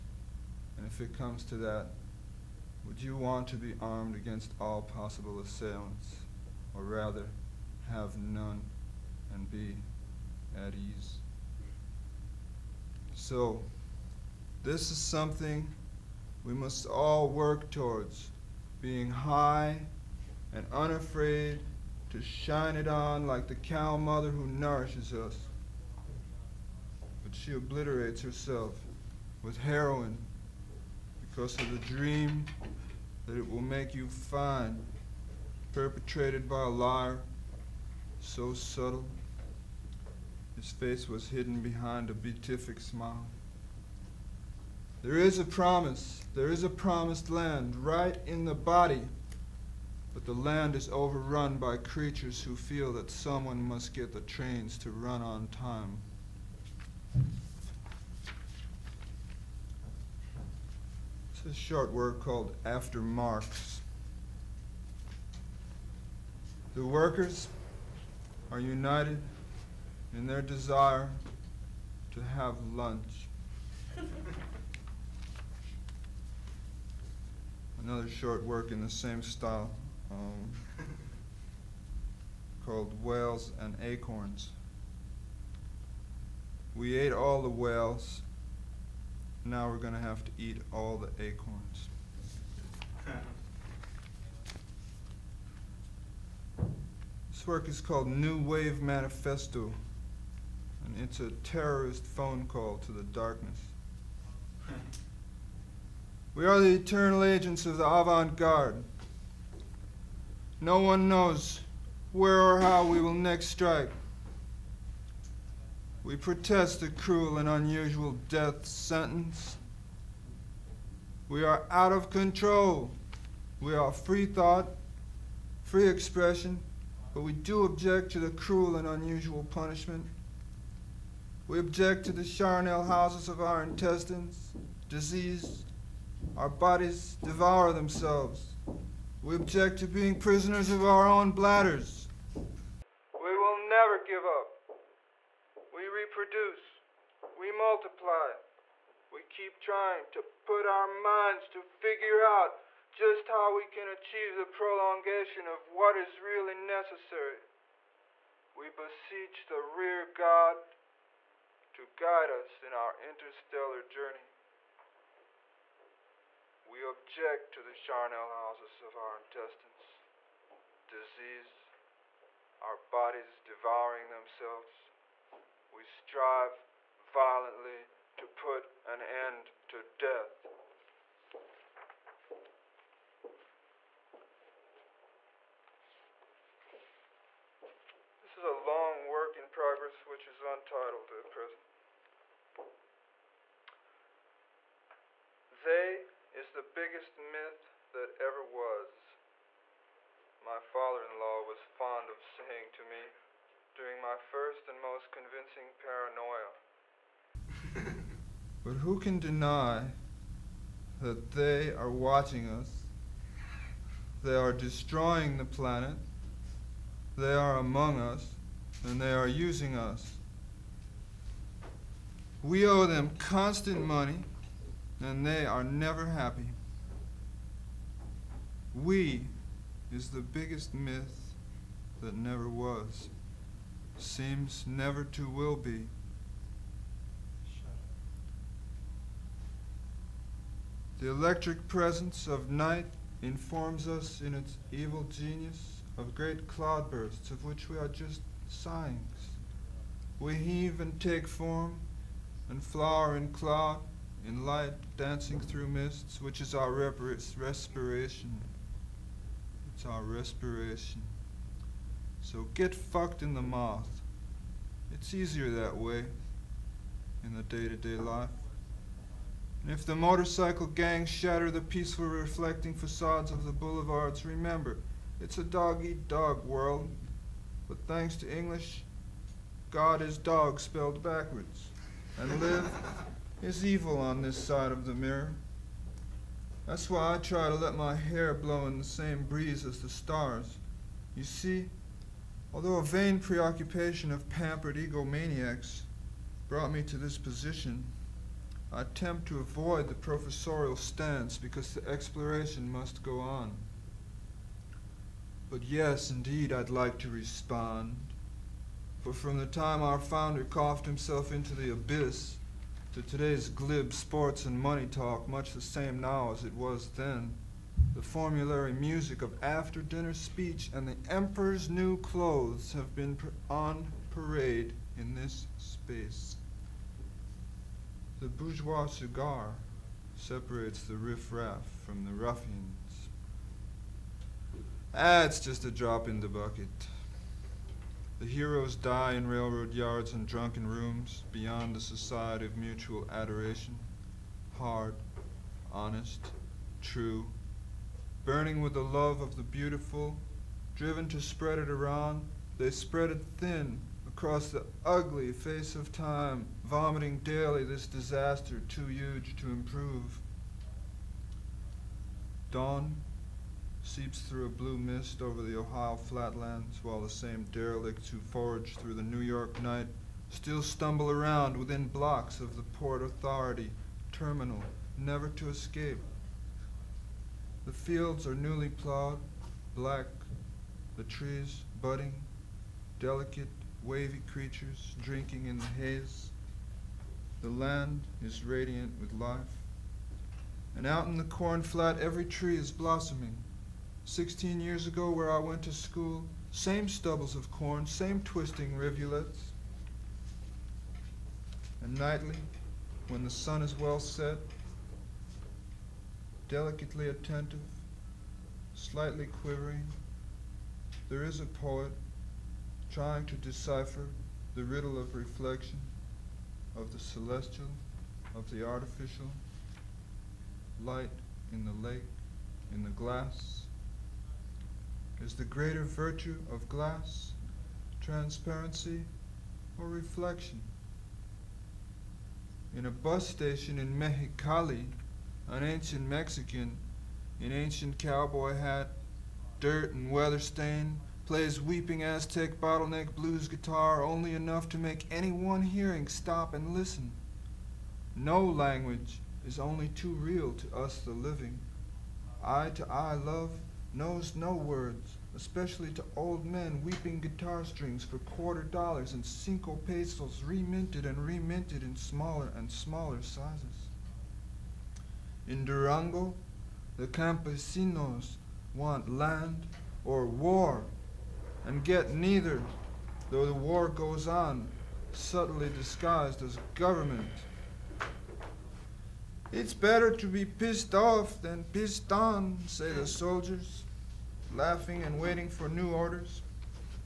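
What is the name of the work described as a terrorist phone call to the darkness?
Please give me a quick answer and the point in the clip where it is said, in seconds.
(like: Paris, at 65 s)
New Wave Manifesto, at 98 s.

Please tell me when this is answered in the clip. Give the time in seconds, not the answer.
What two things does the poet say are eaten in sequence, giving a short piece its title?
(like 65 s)
83 s.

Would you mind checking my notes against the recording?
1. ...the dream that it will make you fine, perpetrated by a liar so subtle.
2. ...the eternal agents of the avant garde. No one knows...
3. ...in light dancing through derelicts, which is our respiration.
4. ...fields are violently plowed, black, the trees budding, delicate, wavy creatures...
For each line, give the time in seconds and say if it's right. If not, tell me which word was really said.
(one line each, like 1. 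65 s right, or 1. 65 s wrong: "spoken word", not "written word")
1. 31 s right
2. 106 s right
3. 254 s wrong: "mists", not "derelicts"
4. 377 s wrong: "newly", not "violently".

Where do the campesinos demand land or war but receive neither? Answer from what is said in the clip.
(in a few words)
Durango.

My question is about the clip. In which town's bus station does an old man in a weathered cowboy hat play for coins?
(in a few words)
Mexicali.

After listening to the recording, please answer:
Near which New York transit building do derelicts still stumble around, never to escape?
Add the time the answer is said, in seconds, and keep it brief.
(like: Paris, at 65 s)
Port Authority terminal, at 372 s.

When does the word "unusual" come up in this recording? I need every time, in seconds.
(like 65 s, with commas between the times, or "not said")
117 s, 128 s.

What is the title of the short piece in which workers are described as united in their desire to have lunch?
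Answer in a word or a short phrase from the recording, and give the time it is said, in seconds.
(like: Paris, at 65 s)
After Marx, at 62 s.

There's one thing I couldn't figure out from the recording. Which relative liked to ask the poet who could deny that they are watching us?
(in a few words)
Father-in-law.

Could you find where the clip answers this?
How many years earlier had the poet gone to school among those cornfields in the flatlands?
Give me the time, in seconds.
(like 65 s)
394 s.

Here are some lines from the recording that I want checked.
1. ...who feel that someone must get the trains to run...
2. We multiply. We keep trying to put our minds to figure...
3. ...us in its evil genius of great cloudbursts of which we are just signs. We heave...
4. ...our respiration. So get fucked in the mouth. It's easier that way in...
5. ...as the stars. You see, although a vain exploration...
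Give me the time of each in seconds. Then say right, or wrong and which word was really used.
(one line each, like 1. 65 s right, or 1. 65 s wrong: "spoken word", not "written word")
1. 52 s right
2. 147 s right
3. 243 s right
4. 259 s right
5. 289 s wrong: "preoccupation", not "exploration".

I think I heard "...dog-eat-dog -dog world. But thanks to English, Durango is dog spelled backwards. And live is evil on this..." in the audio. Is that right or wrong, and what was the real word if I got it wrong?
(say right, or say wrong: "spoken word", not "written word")
wrong: "God", not "Durango".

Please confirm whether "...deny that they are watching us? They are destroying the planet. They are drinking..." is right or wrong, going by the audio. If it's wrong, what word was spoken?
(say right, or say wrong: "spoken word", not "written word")
wrong: "among", not "drinking".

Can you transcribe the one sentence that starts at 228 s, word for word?
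We is the biggest myth that never was, seems never to will be.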